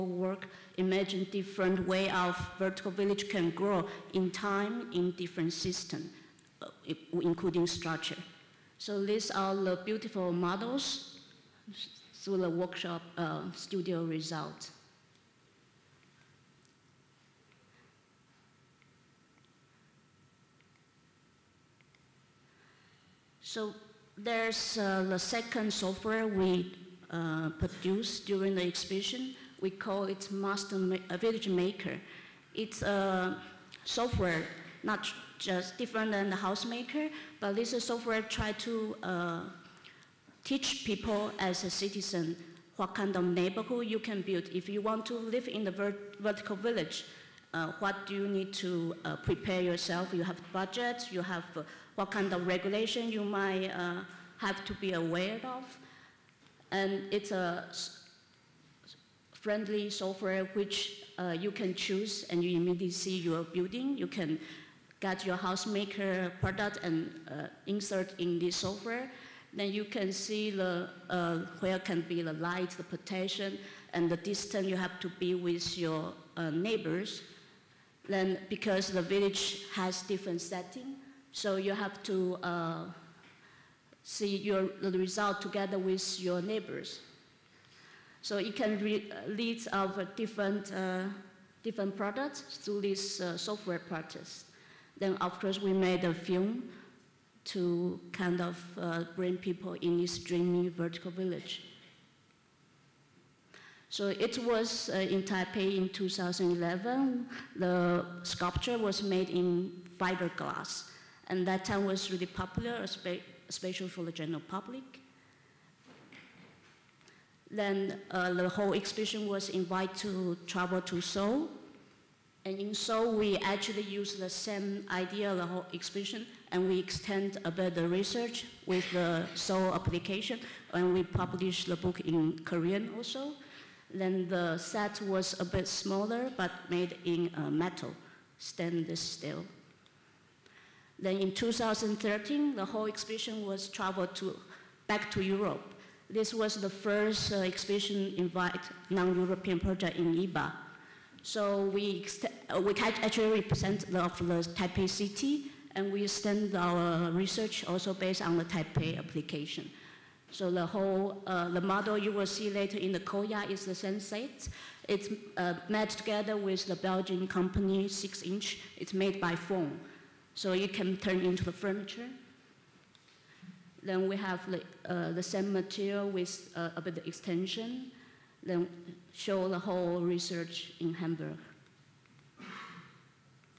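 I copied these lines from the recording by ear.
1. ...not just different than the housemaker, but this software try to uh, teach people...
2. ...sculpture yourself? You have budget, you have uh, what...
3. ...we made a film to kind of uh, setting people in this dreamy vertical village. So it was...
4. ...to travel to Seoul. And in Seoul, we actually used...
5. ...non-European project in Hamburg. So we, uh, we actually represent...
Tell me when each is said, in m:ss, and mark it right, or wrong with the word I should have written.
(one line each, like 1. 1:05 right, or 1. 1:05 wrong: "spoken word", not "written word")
1. 0:34 right
2. 0:49 wrong: "prepare", not "sculpture"
3. 1:35 wrong: "bring", not "setting"
4. 1:59 right
5. 2:28 wrong: "IBA", not "Hamburg".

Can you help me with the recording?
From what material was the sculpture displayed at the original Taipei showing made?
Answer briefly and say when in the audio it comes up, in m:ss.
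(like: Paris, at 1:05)
Fiberglass, at 1:49.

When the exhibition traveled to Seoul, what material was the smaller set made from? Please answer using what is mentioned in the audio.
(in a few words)
Stainless steel.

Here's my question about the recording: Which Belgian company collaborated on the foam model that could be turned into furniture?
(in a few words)
Sixinch.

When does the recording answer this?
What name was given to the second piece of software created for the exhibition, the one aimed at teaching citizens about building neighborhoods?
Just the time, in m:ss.
0:31.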